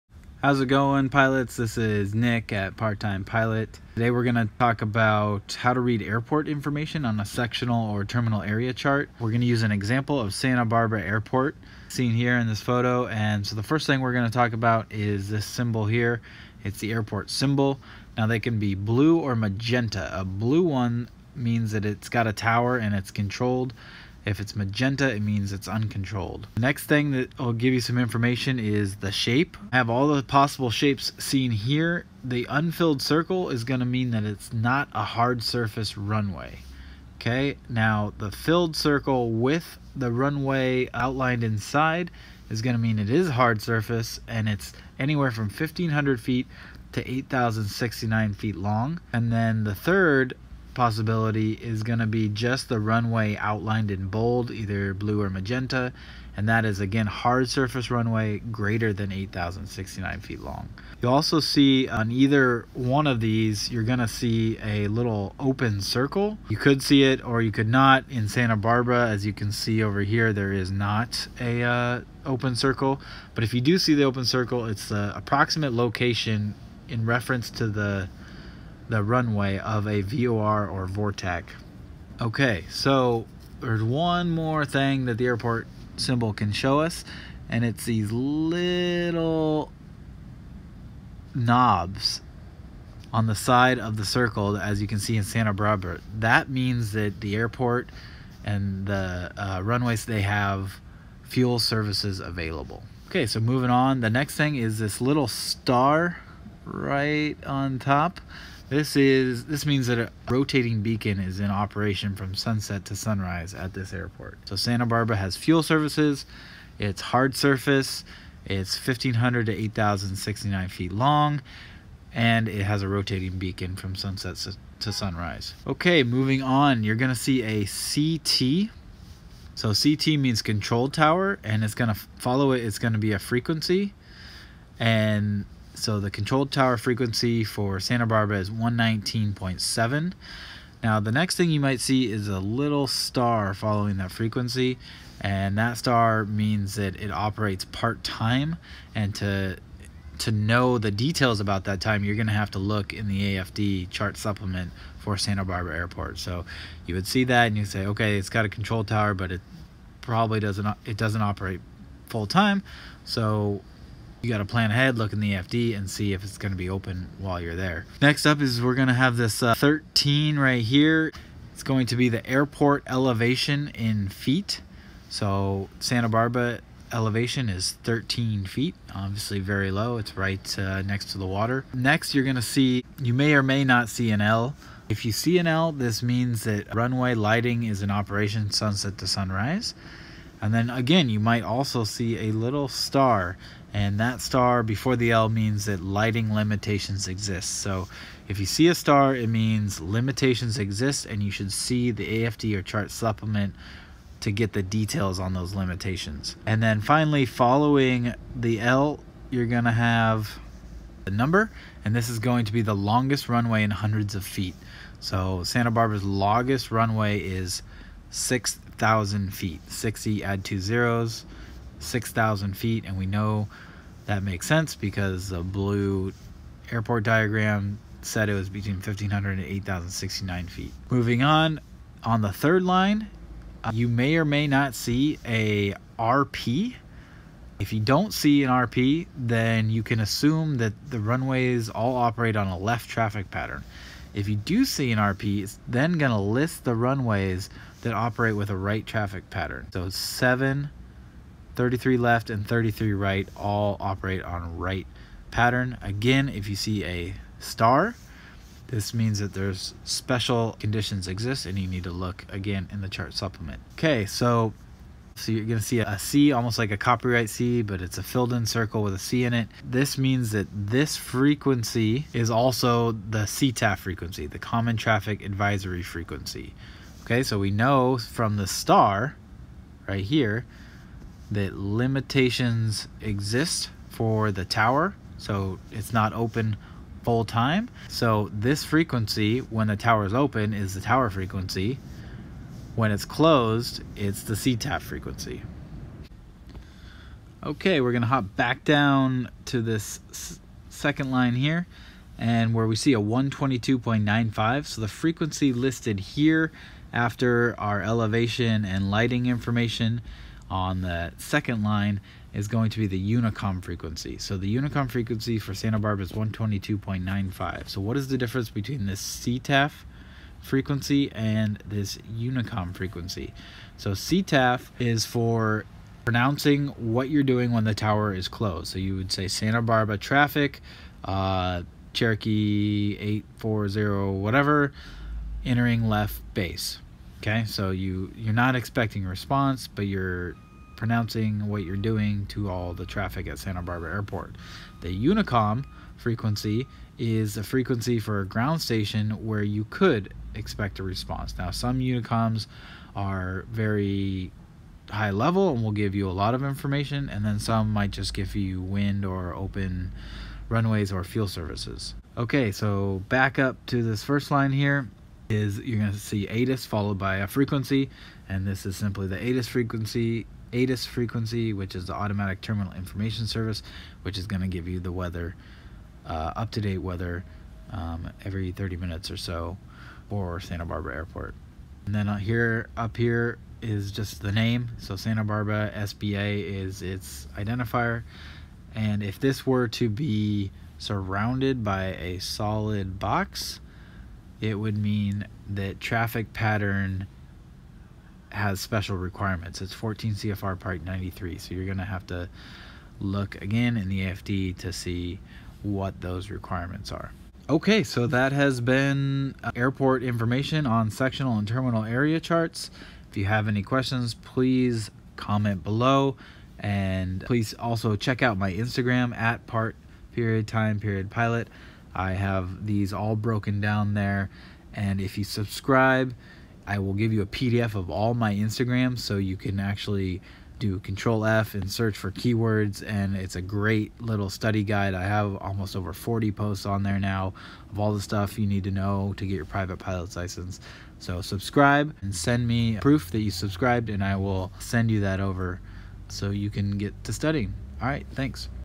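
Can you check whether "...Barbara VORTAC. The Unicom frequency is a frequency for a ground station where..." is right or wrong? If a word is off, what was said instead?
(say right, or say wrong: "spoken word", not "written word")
wrong: "Airport", not "VORTAC".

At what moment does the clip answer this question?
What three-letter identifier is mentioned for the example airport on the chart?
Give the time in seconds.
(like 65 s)
385 s.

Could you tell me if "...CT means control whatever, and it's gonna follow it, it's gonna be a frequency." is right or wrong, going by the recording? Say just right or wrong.
wrong.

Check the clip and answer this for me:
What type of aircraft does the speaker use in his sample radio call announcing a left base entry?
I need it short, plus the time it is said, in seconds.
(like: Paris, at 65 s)
Cherokee, at 331 s.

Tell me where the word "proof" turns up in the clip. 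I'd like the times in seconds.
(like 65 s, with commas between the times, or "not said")
442 s.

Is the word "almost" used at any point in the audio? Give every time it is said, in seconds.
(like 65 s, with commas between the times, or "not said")
266 s, 435 s.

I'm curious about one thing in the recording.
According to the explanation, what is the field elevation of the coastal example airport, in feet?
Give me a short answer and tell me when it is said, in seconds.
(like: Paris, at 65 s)
13 feet, at 177 s.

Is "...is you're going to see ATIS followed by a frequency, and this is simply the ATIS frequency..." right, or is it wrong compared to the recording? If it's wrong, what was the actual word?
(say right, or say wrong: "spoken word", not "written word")
right.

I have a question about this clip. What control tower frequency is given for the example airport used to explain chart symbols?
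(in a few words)
119.7.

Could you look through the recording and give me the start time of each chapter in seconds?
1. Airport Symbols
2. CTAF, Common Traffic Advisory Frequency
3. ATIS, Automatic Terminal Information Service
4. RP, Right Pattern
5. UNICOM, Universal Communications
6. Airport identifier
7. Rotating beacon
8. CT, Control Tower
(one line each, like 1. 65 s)
1. 16 s
2. 288 s
3. 392 s
4. 252 s
5. 324 s
6. 413 s
7. 114 s
8. 140 s.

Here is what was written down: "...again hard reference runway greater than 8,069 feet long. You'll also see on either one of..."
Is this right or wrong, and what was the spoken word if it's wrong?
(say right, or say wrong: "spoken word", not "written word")
wrong: "surface", not "reference".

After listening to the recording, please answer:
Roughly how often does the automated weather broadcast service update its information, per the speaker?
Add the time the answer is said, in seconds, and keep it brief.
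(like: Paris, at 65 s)
every 30 minutes, at 378 s.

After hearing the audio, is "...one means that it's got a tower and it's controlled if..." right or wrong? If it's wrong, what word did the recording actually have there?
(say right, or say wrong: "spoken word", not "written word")
right.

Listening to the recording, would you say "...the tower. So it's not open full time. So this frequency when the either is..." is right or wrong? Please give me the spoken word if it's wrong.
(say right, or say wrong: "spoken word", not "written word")
wrong: "tower", not "either".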